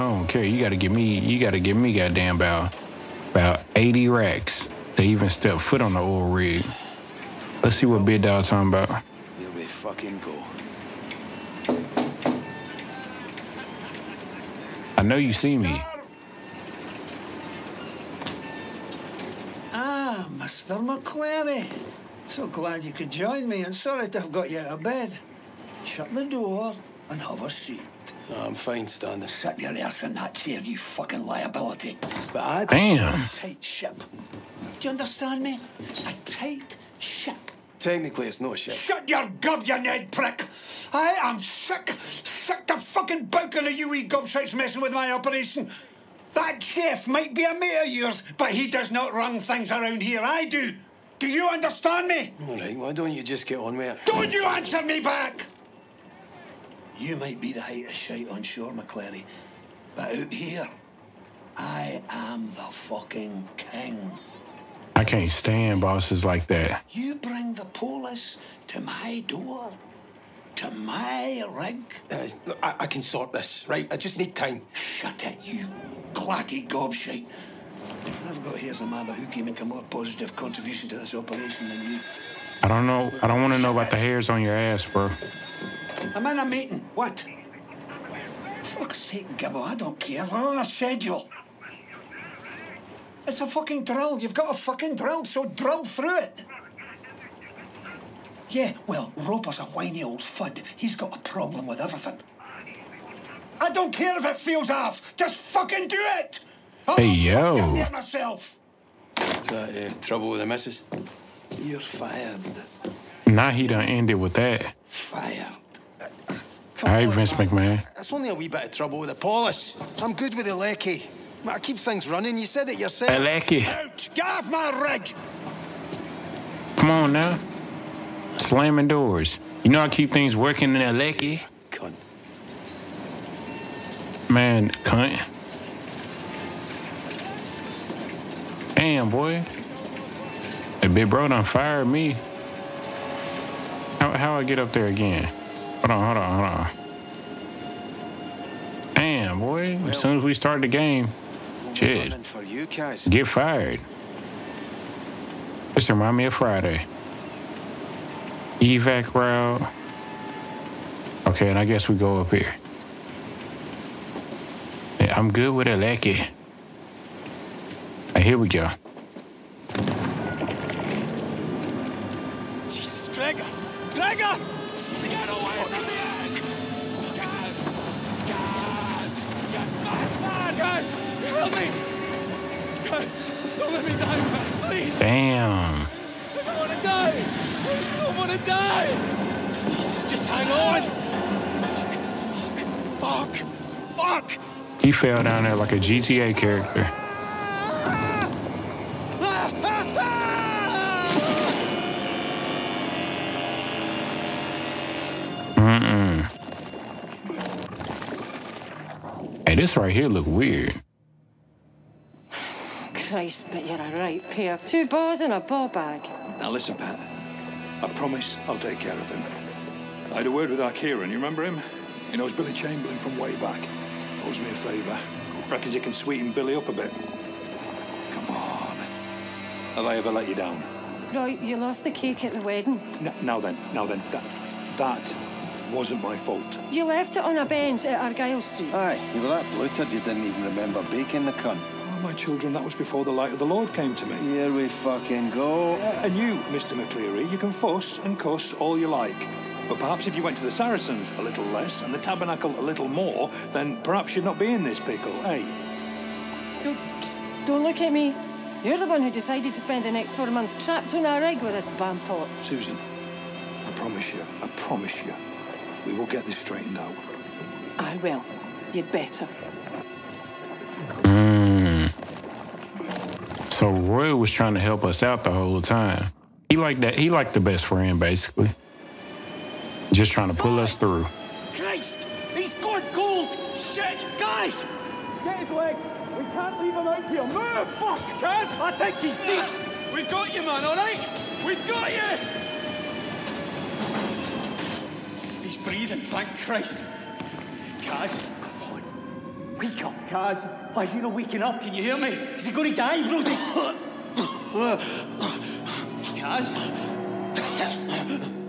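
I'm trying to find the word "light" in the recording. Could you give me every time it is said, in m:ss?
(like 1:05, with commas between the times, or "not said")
4:03.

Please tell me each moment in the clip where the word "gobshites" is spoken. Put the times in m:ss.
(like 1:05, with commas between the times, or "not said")
0:44, 1:16.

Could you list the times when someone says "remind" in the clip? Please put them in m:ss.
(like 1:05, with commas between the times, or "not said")
2:35.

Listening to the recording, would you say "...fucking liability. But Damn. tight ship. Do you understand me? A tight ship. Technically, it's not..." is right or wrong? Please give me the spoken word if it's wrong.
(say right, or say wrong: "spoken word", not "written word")
right.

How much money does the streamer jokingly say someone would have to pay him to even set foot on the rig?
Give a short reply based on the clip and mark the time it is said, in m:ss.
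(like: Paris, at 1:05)
80 racks, at 0:03.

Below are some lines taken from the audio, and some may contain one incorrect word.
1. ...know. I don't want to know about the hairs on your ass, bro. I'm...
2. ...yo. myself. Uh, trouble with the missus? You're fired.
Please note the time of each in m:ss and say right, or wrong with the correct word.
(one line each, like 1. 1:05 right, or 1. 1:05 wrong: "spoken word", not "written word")
1. 1:22 right
2. 1:47 right.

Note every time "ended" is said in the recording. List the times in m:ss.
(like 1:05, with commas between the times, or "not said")
1:53.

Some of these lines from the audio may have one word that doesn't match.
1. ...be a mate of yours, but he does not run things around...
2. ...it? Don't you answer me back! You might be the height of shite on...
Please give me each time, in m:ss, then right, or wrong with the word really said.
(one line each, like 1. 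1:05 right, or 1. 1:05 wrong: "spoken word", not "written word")
1. 0:47 right
2. 0:53 right.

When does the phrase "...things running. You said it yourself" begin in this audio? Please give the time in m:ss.
2:01.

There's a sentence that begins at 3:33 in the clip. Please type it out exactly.
Christ, but you're a right pair.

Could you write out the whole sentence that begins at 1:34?
You've got a fucking drill, so drill through it.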